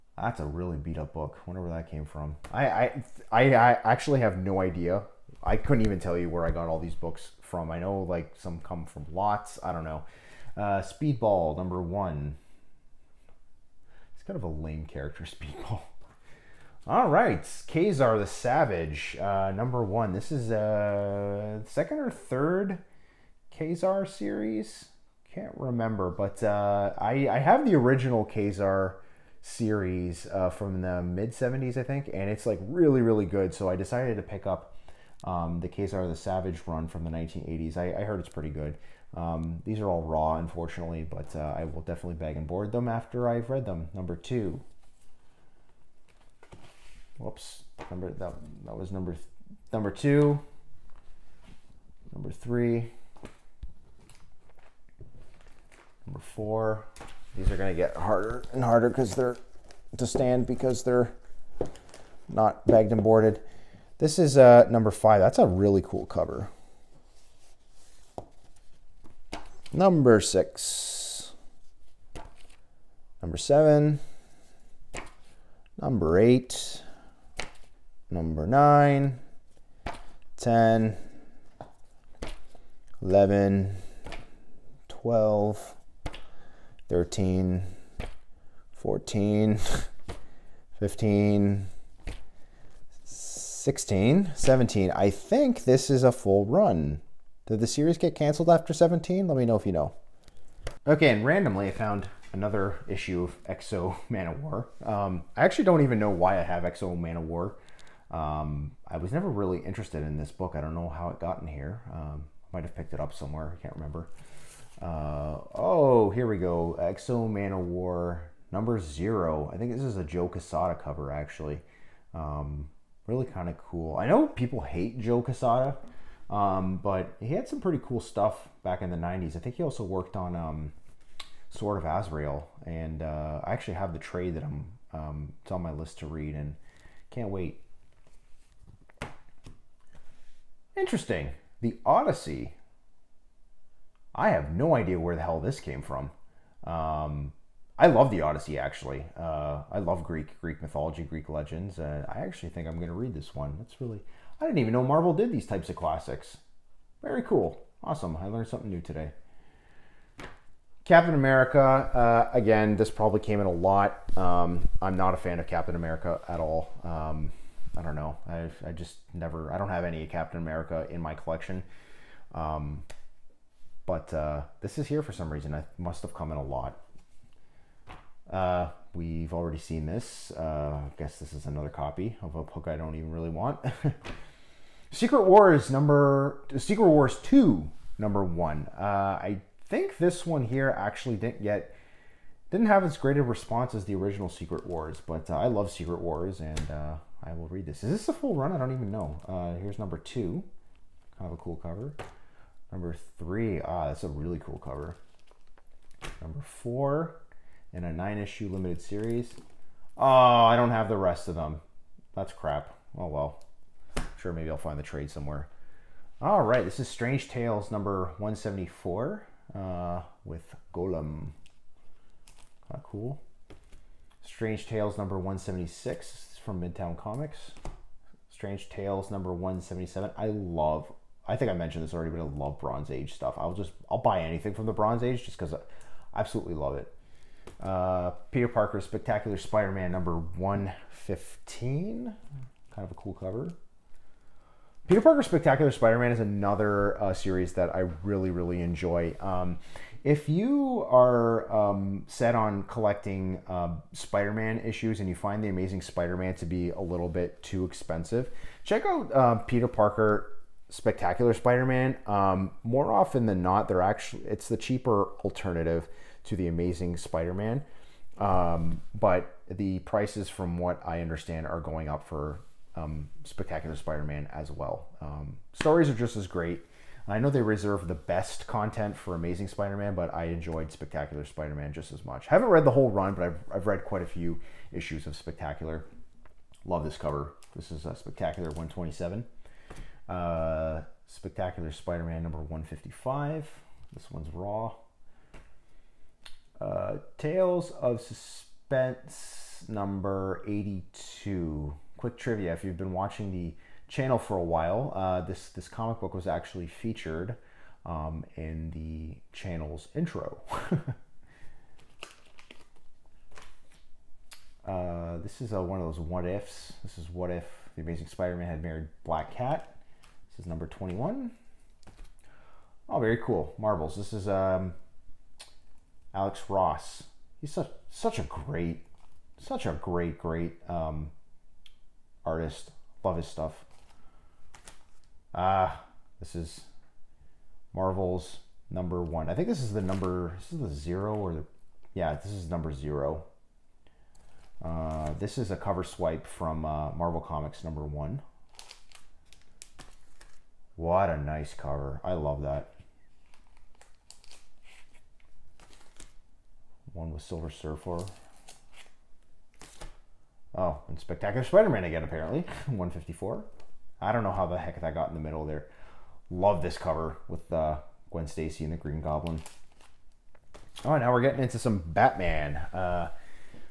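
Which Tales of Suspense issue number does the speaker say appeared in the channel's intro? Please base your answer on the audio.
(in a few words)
82.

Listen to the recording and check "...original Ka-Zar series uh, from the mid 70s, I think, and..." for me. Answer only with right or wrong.
right.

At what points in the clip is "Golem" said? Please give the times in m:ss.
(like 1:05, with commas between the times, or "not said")
3:40.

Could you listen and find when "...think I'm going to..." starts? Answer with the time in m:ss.
2:32.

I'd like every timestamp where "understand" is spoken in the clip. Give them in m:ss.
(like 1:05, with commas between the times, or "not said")
4:31.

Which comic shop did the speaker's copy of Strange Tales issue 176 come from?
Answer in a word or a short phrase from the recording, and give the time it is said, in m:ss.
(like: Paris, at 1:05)
Midtown Comics, at 3:46.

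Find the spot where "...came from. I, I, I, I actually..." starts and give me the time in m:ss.
0:01.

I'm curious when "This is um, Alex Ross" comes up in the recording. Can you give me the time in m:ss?
5:23.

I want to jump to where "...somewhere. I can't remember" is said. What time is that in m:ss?
1:53.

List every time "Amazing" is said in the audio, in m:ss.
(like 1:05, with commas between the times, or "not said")
4:15, 4:26, 4:39, 5:17.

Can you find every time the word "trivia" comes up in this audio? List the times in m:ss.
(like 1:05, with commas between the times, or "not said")
5:02.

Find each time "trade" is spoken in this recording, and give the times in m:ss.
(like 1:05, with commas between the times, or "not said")
2:13, 3:34.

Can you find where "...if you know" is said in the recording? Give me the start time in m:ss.
1:39.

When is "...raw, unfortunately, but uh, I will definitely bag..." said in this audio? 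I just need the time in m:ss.
0:40.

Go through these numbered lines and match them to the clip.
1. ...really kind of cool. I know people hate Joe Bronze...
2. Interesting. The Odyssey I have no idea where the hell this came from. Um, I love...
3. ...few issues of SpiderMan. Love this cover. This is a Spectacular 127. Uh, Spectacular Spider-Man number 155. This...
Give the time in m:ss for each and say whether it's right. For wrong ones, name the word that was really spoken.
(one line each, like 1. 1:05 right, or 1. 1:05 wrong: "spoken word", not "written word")
1. 2:03 wrong: "Quesada", not "Bronze"
2. 2:20 right
3. 4:44 wrong: "Spectacular", not "SpiderMan".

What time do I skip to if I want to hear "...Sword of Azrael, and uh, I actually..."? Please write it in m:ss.
2:11.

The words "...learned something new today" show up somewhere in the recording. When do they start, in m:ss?
2:38.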